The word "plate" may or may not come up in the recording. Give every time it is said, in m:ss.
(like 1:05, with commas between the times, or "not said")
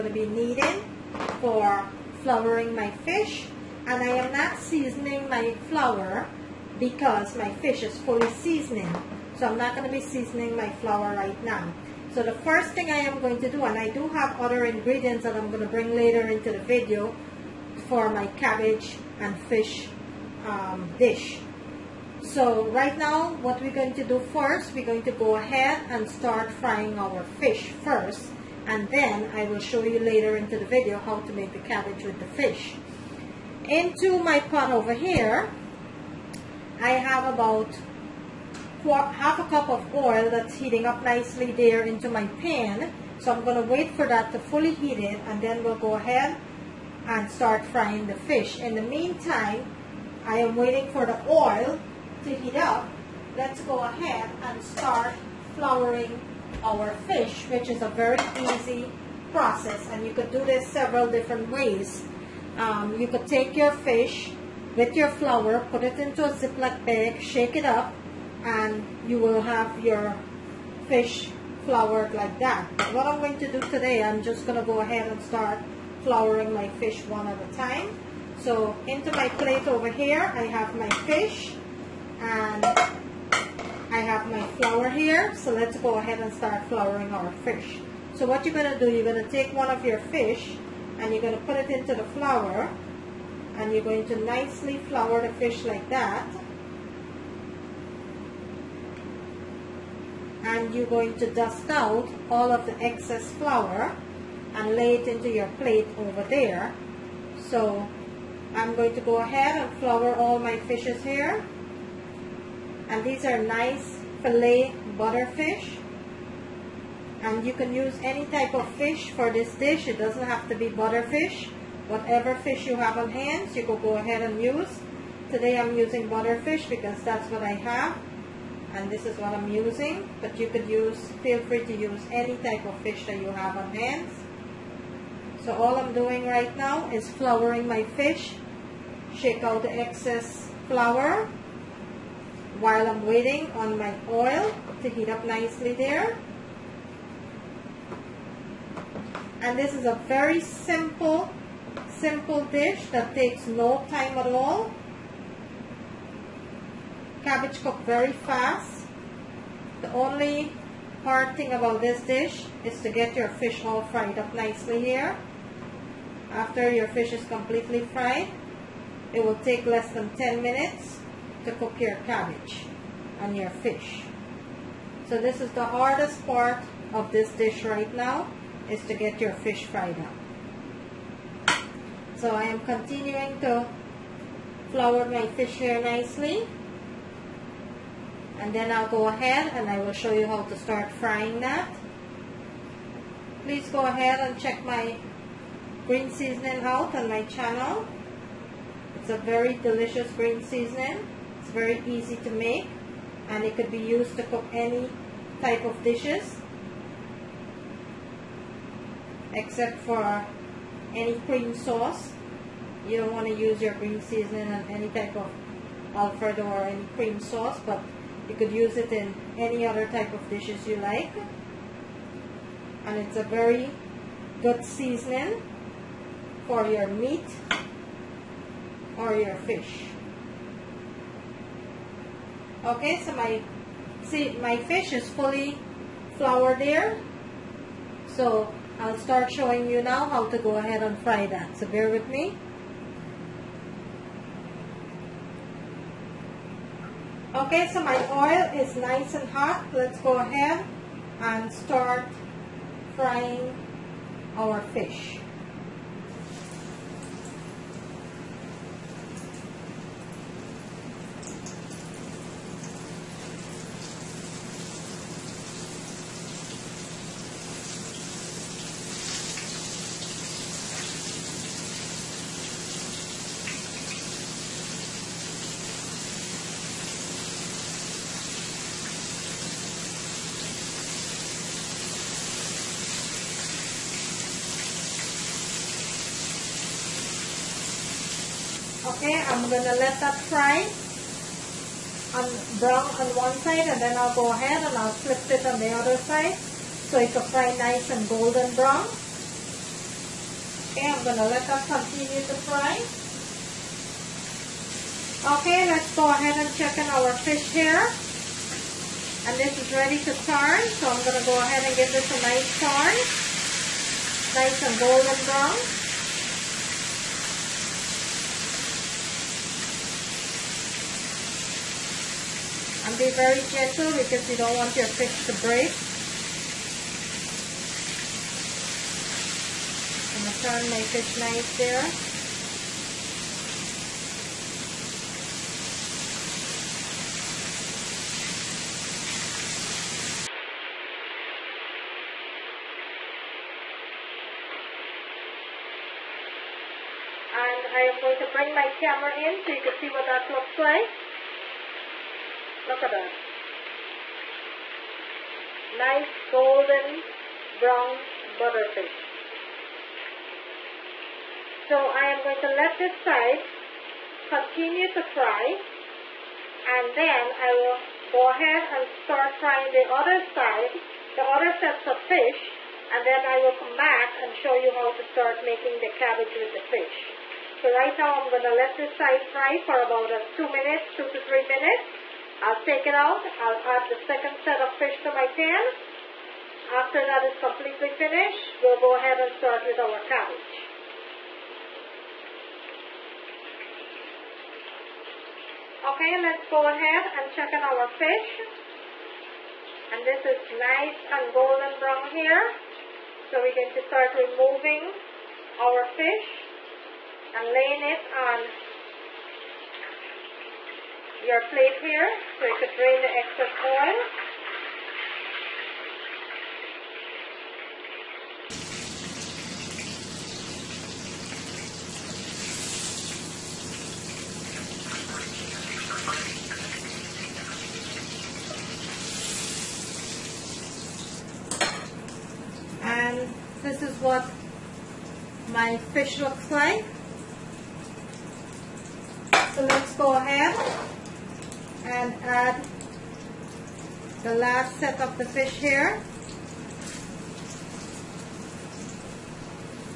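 1:19, 1:45, 6:51.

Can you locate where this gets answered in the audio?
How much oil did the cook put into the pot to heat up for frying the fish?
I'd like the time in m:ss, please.
0:38.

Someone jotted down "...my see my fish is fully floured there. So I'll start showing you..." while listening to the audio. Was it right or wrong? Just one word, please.
right.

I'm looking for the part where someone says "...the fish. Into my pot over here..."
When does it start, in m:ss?
0:32.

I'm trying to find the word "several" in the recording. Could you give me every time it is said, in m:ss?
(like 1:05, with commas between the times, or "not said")
1:00.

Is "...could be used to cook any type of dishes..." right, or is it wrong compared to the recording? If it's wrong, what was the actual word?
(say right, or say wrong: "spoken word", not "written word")
right.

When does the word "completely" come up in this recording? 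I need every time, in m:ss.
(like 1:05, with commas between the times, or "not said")
2:47, 6:27.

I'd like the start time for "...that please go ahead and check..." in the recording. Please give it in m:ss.
3:11.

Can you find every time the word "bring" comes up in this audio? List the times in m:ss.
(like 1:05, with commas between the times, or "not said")
0:15, 5:48.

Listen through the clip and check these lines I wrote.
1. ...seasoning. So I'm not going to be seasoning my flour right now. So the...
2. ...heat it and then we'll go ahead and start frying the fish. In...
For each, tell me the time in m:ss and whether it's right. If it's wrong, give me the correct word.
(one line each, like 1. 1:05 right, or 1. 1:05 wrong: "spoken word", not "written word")
1. 0:08 right
2. 0:44 right.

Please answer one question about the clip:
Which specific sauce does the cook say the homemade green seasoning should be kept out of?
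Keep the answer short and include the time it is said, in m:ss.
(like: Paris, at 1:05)
Alfredo, at 3:35.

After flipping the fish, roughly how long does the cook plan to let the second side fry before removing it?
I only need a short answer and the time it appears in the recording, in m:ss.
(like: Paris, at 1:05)
2 to 3 minutes, at 6:20.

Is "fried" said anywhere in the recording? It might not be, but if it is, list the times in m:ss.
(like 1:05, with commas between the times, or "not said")
2:43, 2:47, 2:59.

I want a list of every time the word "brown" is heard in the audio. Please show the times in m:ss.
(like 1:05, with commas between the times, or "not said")
4:52, 4:58, 5:15, 5:57, 6:41.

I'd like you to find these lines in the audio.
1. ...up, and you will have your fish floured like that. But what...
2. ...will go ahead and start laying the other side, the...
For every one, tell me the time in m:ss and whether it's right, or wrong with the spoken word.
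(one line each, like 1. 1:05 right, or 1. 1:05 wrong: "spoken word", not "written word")
1. 1:07 right
2. 6:07 wrong: "frying", not "laying".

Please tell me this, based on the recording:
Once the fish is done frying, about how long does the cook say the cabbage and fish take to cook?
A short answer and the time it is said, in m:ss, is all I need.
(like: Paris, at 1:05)
less than 10 minutes, at 2:49.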